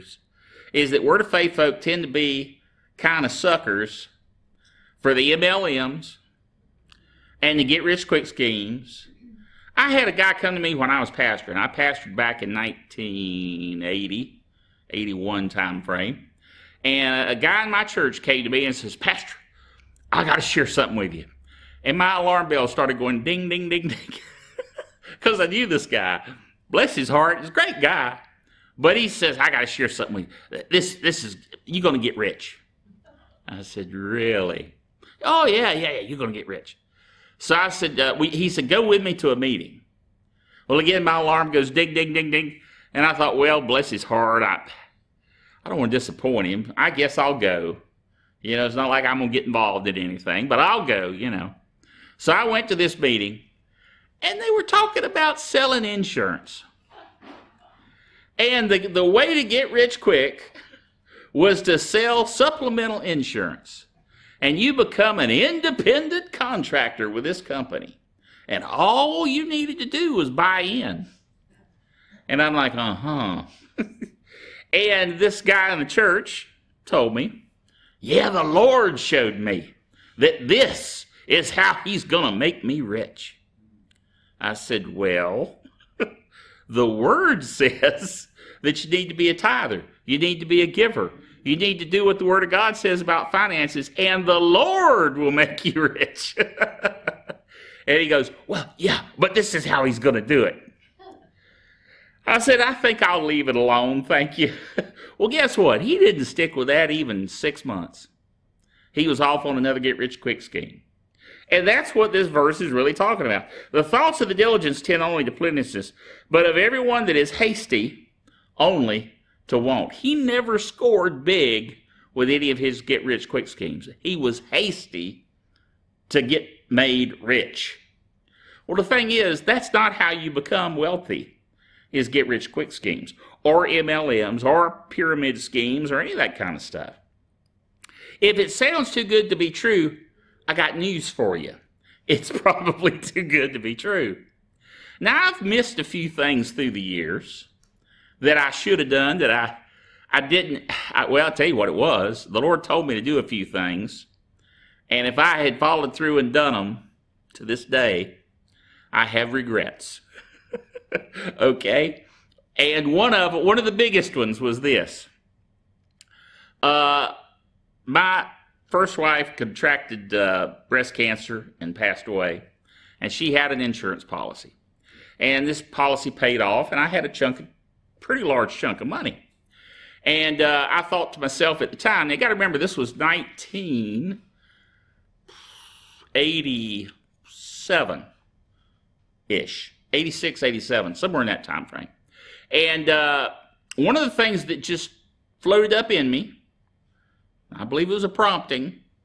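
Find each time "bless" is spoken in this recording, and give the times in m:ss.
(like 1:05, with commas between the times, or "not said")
0:26, 0:43.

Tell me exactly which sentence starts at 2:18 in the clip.
If it sounds too good to be true, I got news for you.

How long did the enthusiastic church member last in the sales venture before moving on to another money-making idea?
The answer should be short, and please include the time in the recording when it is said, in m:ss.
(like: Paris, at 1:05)
less than 6 months, at 1:47.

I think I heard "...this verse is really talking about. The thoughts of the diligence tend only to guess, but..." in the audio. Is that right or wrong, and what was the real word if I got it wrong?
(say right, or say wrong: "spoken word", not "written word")
wrong: "plenteousness", not "guess".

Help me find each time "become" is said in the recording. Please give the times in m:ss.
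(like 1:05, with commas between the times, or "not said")
1:04, 2:10.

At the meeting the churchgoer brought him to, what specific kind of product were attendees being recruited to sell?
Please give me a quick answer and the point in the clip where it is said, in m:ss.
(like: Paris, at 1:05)
supplemental insurance, at 1:02.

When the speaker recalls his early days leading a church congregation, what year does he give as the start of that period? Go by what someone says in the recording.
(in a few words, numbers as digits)
1980.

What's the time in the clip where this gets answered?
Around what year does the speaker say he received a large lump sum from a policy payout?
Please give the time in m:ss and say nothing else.
3:02.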